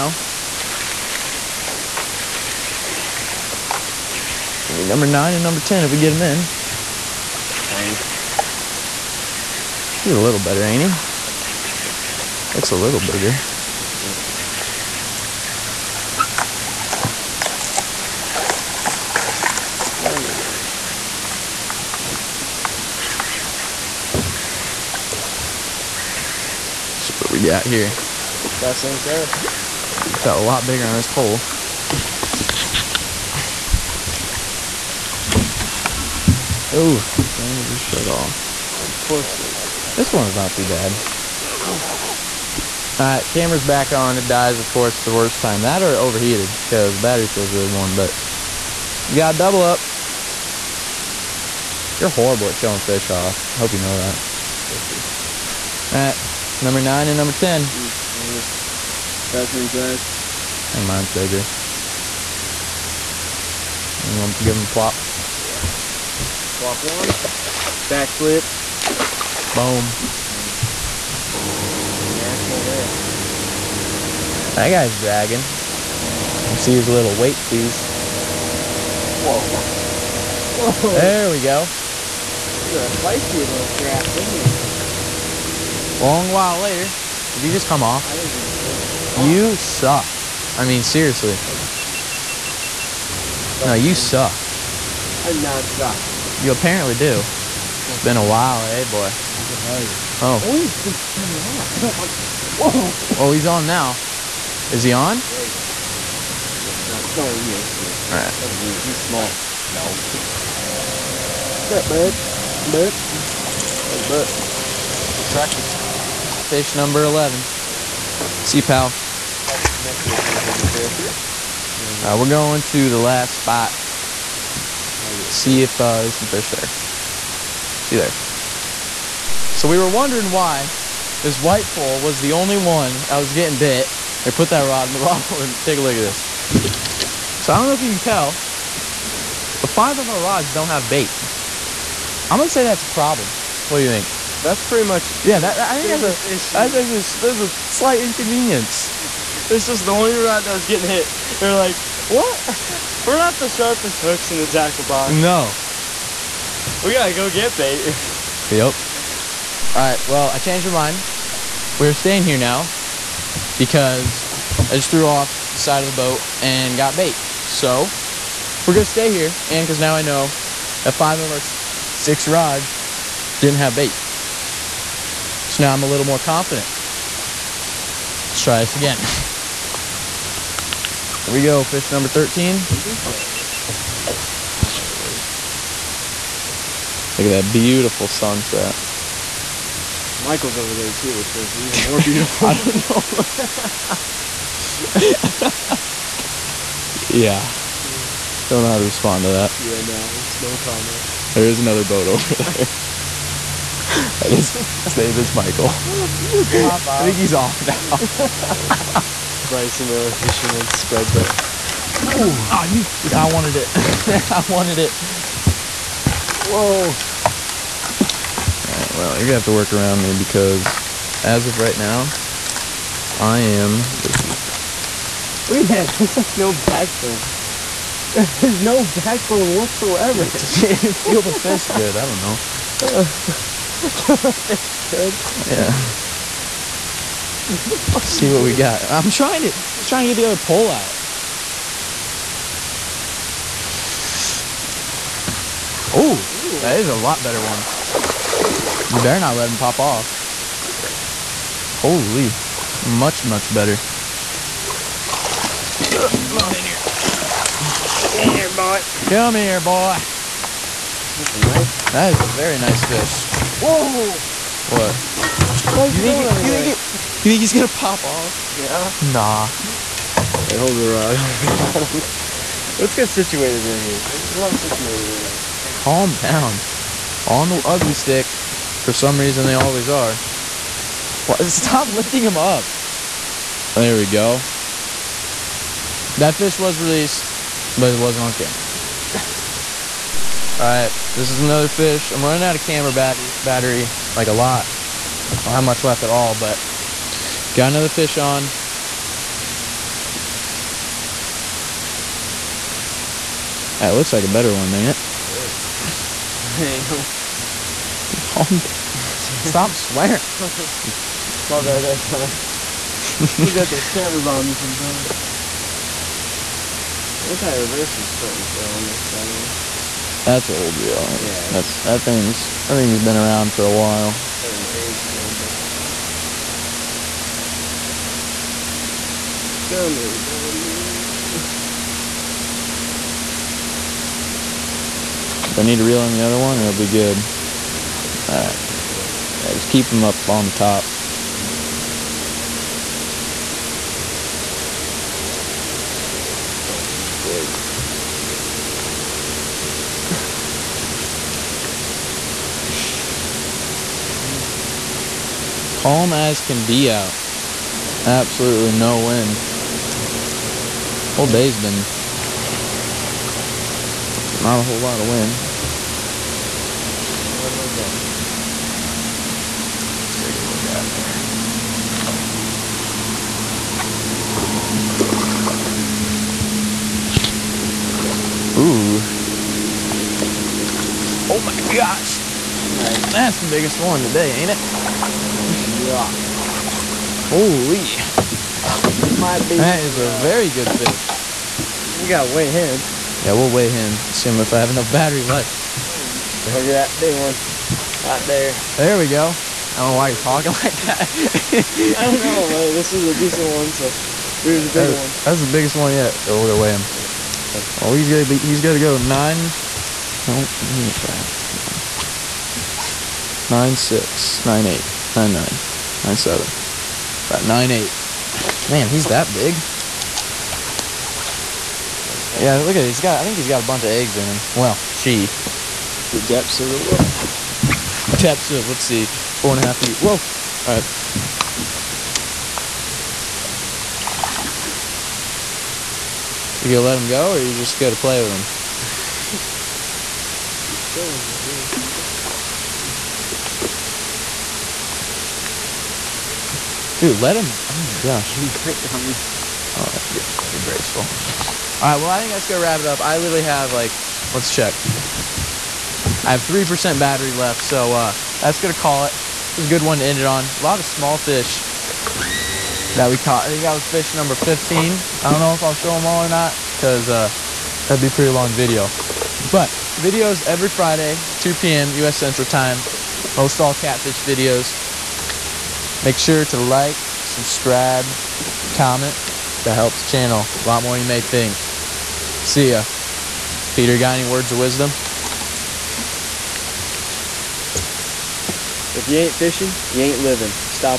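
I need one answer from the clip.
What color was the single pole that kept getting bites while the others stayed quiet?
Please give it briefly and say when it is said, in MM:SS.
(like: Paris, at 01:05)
white, at 02:11.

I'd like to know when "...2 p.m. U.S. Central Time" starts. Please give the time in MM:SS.
07:51.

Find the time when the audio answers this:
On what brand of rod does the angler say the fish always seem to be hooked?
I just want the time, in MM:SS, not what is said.
04:37.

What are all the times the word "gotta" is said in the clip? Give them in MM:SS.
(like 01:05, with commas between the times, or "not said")
02:36, 06:32.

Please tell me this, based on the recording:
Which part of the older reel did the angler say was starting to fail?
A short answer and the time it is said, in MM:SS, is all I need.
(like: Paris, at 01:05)
anti-reverse, at 05:17.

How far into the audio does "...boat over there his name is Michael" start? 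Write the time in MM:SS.
03:21.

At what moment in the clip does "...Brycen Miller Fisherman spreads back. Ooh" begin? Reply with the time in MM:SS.
03:29.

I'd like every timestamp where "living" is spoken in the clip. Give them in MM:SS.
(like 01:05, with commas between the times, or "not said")
08:10.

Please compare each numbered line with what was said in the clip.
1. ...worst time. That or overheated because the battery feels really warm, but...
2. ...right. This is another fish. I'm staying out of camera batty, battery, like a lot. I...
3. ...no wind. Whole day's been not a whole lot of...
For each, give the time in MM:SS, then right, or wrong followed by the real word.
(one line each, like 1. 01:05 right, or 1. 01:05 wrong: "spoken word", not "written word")
1. 00:45 right
2. 04:50 wrong: "running", not "staying"
3. 05:58 right.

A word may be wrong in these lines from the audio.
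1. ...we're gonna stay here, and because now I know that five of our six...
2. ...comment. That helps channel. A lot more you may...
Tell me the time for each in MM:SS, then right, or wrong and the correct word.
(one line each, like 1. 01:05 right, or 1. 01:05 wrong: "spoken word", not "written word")
1. 02:48 right
2. 07:58 right.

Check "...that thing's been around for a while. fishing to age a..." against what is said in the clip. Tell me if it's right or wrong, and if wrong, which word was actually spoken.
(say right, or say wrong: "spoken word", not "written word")
wrong: "starting", not "fishing".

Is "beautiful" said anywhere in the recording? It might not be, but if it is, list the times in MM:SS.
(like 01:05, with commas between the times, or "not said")
03:07, 03:11.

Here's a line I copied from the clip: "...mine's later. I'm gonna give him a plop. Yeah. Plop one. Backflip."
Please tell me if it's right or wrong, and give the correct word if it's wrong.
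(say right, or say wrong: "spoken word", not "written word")
wrong: "bigger", not "later".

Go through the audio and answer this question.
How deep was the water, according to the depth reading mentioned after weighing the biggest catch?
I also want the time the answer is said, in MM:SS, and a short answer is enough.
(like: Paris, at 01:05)
4.5 feet, at 07:09.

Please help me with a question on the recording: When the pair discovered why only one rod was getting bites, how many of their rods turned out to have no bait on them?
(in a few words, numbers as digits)
5.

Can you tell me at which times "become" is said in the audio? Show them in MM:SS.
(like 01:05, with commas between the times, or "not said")
not said.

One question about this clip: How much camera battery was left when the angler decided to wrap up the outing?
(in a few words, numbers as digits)
3%.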